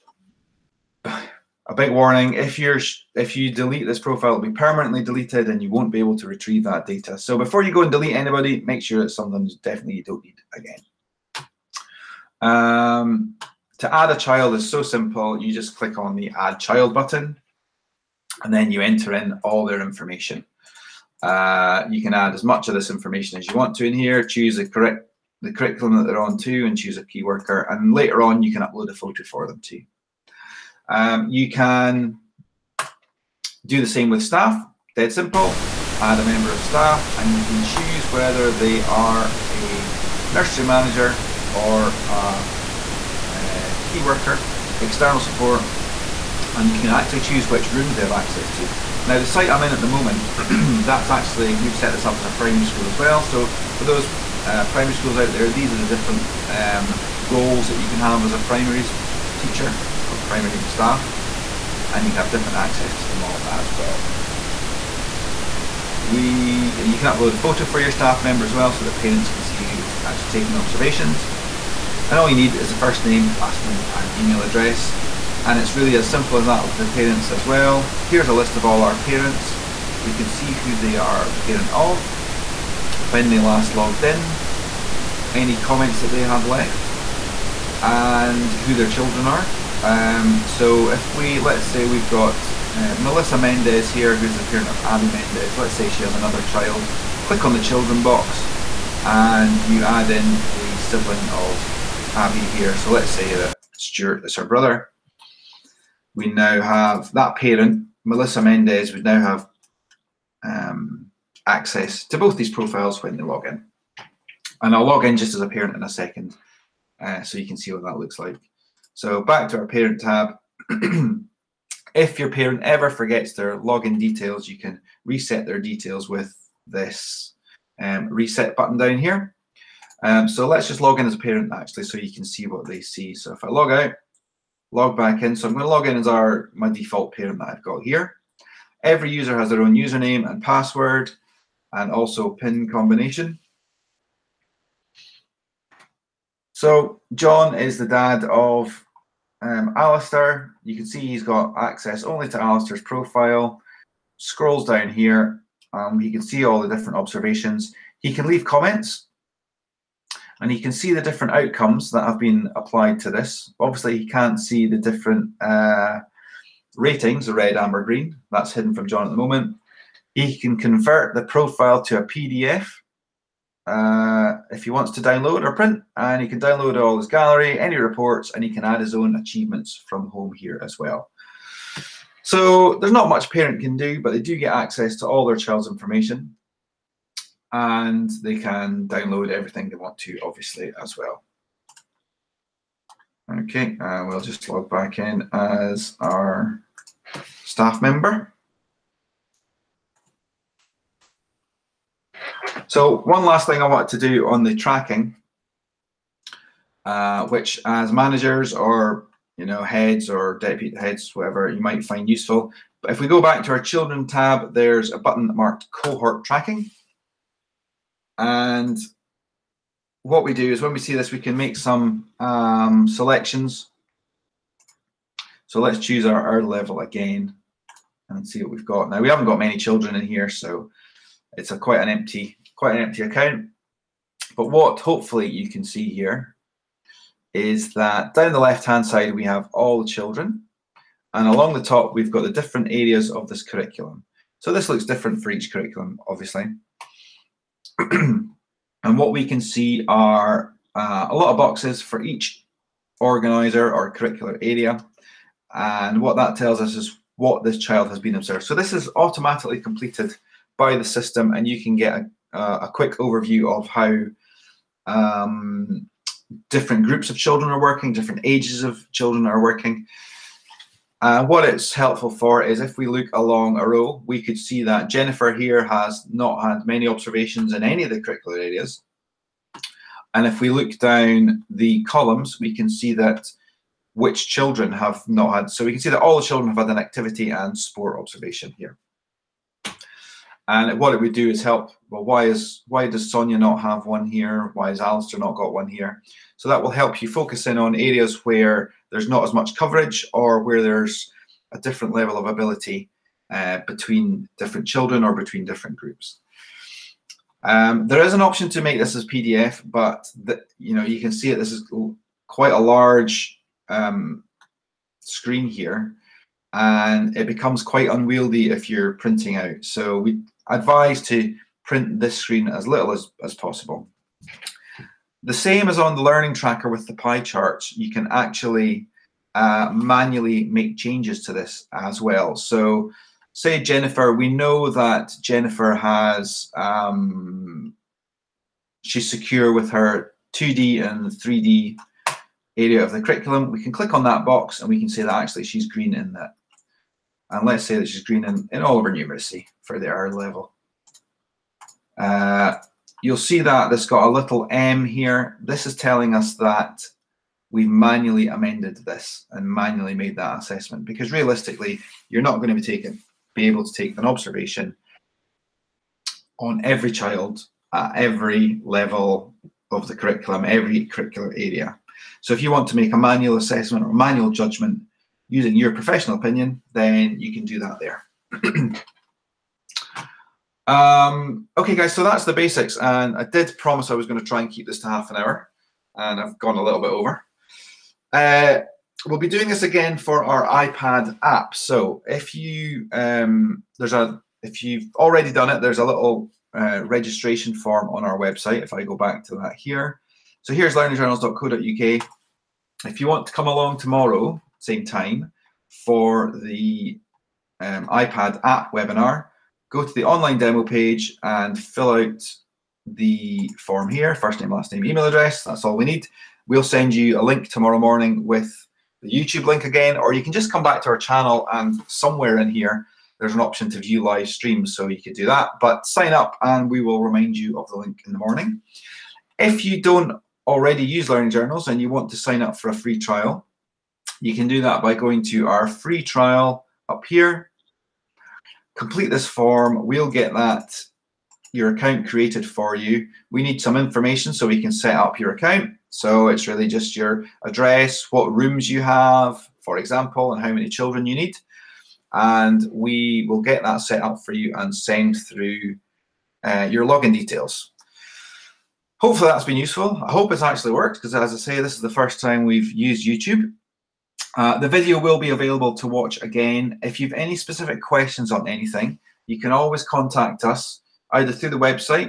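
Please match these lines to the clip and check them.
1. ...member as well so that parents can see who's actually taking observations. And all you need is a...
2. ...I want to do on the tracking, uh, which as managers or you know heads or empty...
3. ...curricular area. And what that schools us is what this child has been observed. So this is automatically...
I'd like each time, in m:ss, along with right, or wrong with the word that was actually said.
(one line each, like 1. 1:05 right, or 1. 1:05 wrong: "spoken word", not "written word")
1. 1:08 right
2. 3:23 wrong: "deputy", not "empty"
3. 4:13 wrong: "tells", not "schools".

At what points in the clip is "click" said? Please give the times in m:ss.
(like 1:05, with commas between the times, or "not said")
0:15, 1:37, 5:43.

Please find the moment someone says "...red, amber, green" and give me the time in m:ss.
2:47.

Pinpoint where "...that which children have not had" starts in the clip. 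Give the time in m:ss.
4:42.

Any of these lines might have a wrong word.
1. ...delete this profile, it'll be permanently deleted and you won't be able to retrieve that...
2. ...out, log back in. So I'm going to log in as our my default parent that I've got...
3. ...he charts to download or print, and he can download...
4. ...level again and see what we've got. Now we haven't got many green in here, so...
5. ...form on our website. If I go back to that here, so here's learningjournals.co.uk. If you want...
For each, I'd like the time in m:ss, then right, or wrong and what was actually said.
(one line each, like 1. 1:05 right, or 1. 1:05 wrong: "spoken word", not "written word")
1. 0:03 right
2. 2:13 right
3. 2:54 wrong: "wants", not "charts"
4. 3:46 wrong: "children", not "green"
5. 6:37 right.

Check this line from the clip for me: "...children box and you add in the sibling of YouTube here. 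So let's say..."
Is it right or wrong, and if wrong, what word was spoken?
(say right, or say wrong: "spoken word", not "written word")
wrong: "Abby", not "YouTube".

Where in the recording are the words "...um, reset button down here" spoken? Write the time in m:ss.
2:07.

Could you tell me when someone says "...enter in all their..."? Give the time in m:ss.
0:18.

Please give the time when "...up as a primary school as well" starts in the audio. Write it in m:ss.
0:52.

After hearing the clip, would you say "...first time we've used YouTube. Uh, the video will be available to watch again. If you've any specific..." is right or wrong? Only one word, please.
right.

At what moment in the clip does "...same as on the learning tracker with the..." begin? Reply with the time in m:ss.
5:25.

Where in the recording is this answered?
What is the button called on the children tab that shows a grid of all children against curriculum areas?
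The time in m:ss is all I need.
3:35.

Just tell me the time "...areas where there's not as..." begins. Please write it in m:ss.
4:57.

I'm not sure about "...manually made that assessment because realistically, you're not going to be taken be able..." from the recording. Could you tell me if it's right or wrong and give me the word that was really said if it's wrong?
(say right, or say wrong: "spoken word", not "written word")
right.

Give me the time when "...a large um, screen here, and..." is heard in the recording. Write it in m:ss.
5:12.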